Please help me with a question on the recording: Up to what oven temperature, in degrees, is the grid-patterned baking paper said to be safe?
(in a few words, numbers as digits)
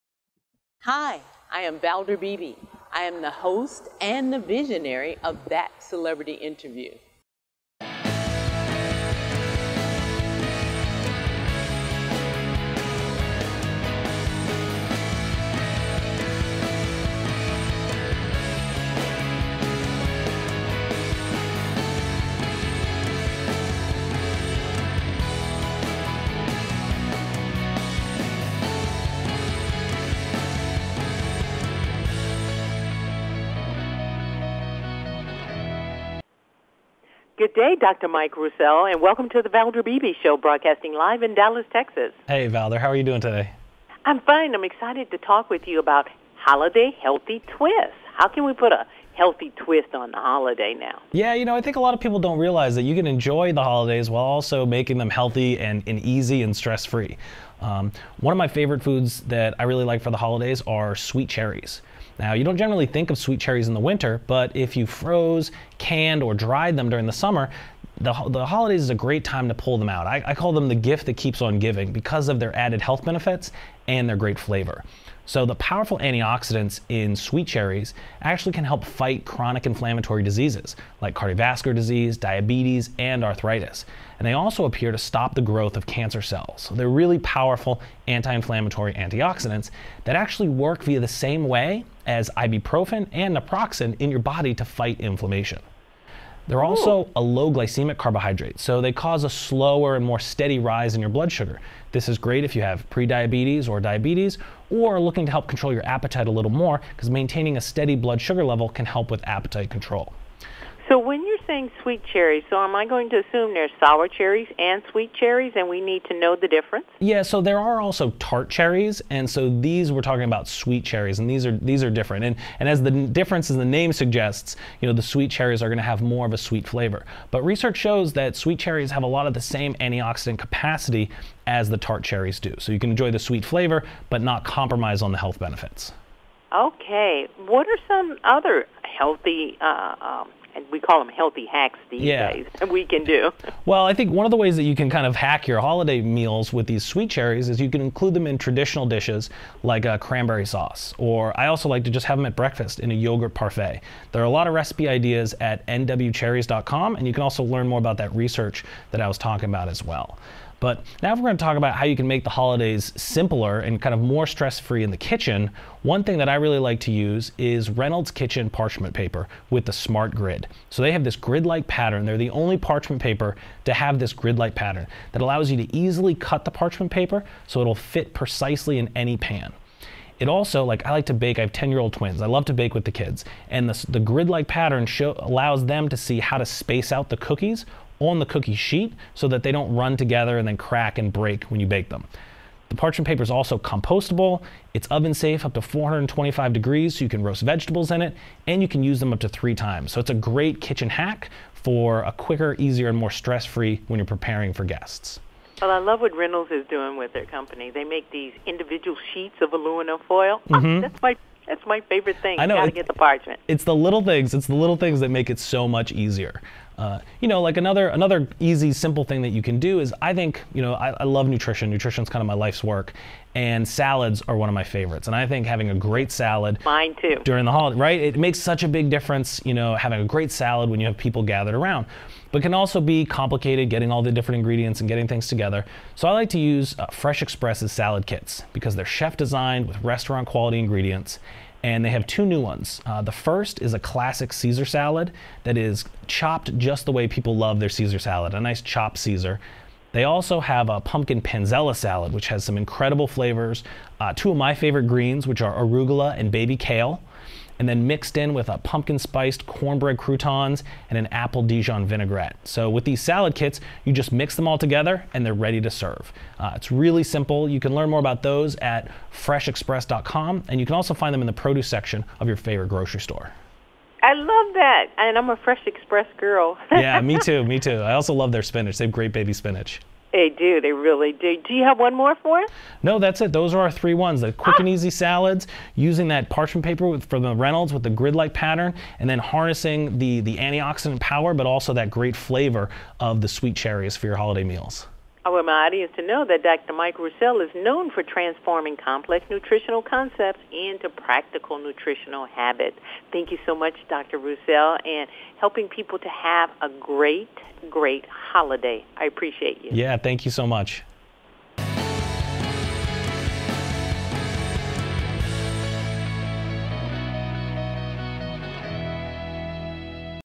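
425.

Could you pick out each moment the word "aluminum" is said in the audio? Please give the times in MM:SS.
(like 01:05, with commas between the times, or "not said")
03:29.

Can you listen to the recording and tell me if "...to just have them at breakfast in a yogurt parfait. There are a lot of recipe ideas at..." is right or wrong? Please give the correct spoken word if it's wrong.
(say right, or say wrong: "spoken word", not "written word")
right.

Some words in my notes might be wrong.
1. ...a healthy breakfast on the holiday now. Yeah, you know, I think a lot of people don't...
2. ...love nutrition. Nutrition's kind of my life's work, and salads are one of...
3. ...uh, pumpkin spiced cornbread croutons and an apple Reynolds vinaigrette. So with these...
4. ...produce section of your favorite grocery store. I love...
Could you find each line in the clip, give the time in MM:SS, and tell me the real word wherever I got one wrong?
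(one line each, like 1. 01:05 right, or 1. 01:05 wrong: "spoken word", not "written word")
1. 00:48 wrong: "twist", not "breakfast"
2. 03:41 right
3. 04:18 wrong: "Dijon", not "Reynolds"
4. 04:31 right.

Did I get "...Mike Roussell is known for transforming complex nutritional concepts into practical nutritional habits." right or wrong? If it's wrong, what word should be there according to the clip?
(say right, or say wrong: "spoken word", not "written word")
right.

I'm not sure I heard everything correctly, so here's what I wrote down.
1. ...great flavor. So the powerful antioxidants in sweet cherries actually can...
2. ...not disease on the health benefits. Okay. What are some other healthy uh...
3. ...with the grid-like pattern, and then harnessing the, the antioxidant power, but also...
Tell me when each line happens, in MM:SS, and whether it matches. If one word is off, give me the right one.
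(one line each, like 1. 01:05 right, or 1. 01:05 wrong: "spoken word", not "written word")
1. 01:14 right
2. 02:14 wrong: "compromise", not "disease"
3. 04:47 right.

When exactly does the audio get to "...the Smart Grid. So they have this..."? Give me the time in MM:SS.
02:49.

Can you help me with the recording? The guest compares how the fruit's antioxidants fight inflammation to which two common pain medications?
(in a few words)
Ibuprofen and naproxen.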